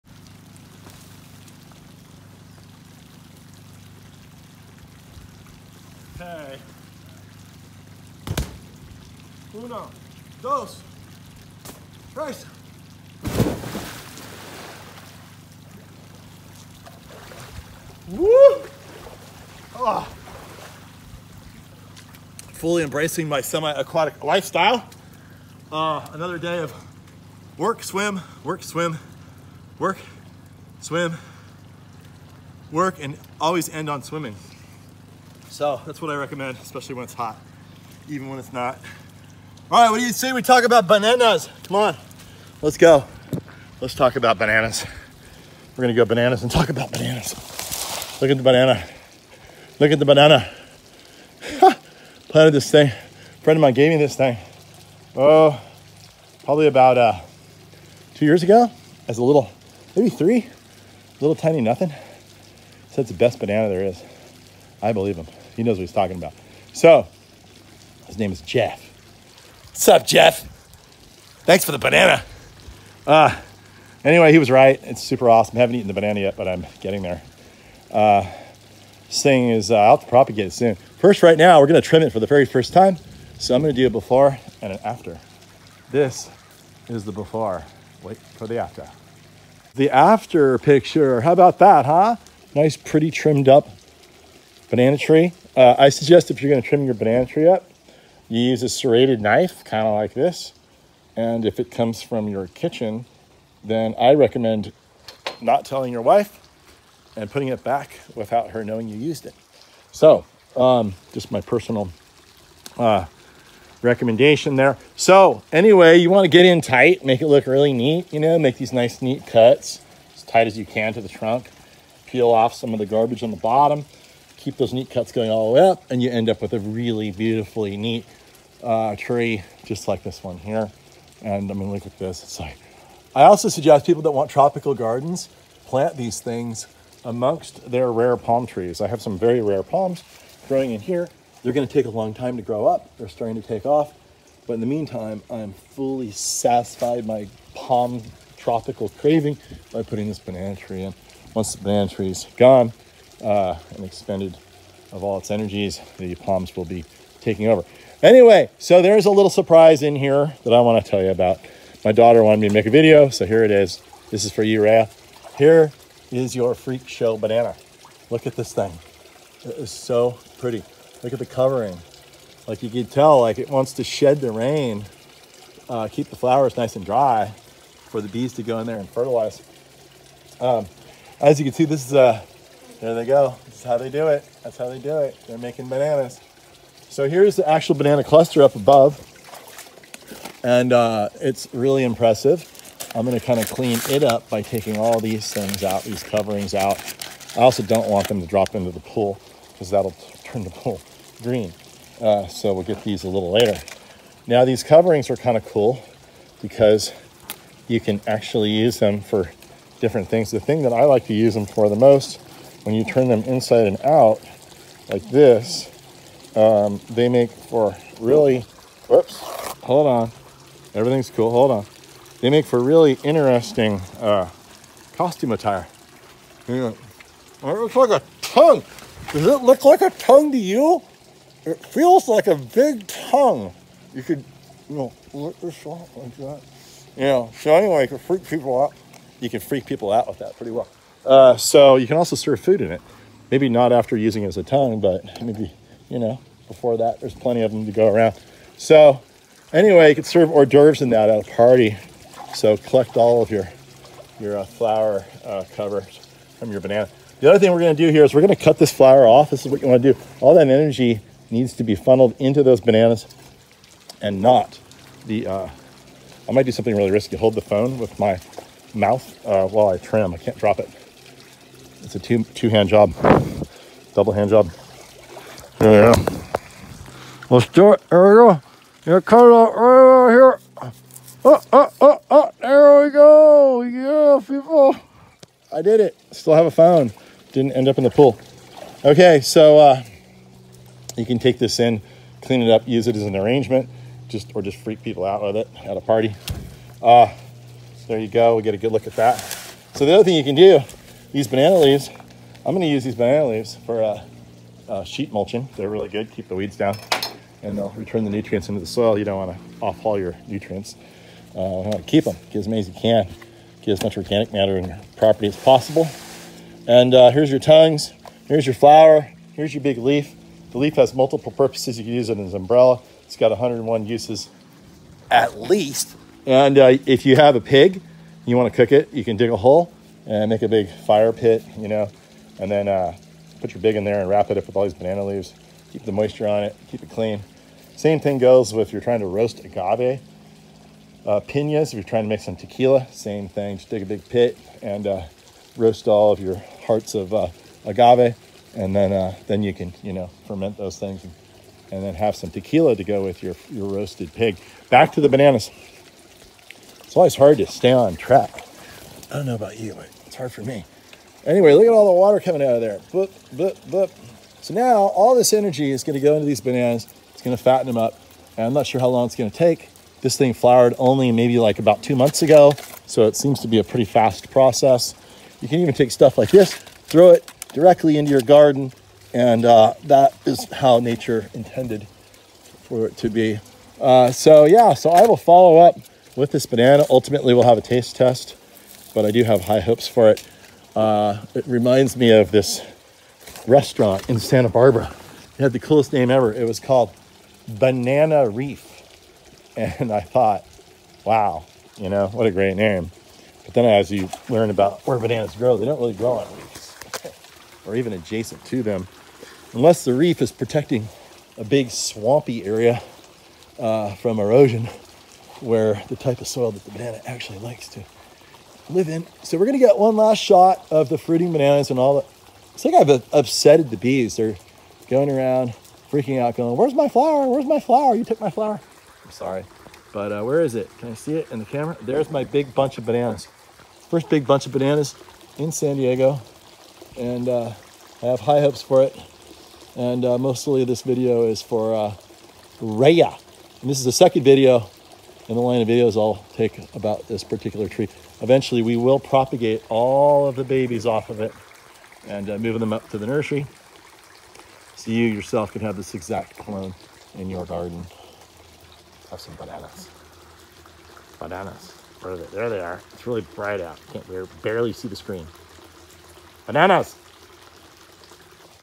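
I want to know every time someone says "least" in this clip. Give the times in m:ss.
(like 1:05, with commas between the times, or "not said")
5:25.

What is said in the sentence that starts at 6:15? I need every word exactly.
You can even take stuff like this, throw it directly into your garden.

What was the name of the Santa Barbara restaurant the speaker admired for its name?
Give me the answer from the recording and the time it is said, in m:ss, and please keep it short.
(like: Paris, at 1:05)
Banana Reef, at 6:37.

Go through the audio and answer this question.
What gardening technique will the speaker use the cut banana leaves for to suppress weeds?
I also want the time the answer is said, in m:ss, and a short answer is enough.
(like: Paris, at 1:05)
Sheet mulching, at 5:04.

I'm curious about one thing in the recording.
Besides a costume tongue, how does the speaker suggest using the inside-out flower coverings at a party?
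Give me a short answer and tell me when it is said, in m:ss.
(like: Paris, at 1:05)
Serve hors d'oeuvres, at 4:10.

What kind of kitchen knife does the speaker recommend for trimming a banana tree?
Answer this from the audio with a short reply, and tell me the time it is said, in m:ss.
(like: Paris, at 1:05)
Serrated knife, at 1:38.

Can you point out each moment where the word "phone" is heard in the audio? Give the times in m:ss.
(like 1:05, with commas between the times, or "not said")
4:27, 4:46.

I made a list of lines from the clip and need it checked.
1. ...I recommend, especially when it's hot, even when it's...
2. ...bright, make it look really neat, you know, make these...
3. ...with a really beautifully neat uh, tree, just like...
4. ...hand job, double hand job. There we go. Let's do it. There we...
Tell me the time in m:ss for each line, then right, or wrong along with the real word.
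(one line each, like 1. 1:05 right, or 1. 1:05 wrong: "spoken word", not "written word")
1. 0:36 right
2. 1:56 wrong: "tight", not "bright"
3. 2:06 right
4. 4:32 right.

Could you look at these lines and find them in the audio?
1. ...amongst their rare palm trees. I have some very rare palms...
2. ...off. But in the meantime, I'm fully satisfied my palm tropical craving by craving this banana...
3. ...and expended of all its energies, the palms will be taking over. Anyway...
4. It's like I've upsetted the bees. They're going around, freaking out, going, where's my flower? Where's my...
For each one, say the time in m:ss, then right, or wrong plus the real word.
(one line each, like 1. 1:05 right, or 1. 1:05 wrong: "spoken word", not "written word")
1. 2:17 right
2. 2:23 wrong: "putting", not "craving"
3. 2:33 right
4. 7:02 right.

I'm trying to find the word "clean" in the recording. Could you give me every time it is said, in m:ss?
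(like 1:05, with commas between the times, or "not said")
3:13, 4:52, 5:36.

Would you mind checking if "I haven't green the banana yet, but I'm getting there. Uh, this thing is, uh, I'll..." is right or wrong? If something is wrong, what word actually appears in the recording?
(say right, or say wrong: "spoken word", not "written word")
wrong: "eaten", not "green".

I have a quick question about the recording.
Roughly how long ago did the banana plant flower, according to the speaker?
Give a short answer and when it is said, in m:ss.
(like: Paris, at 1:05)
About 2 months, at 6:11.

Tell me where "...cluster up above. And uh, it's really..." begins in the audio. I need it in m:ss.
3:08.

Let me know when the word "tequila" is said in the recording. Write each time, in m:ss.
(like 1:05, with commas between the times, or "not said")
5:42, 5:52.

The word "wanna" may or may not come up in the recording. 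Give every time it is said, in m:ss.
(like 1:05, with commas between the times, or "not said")
4:19, 5:09, 5:28.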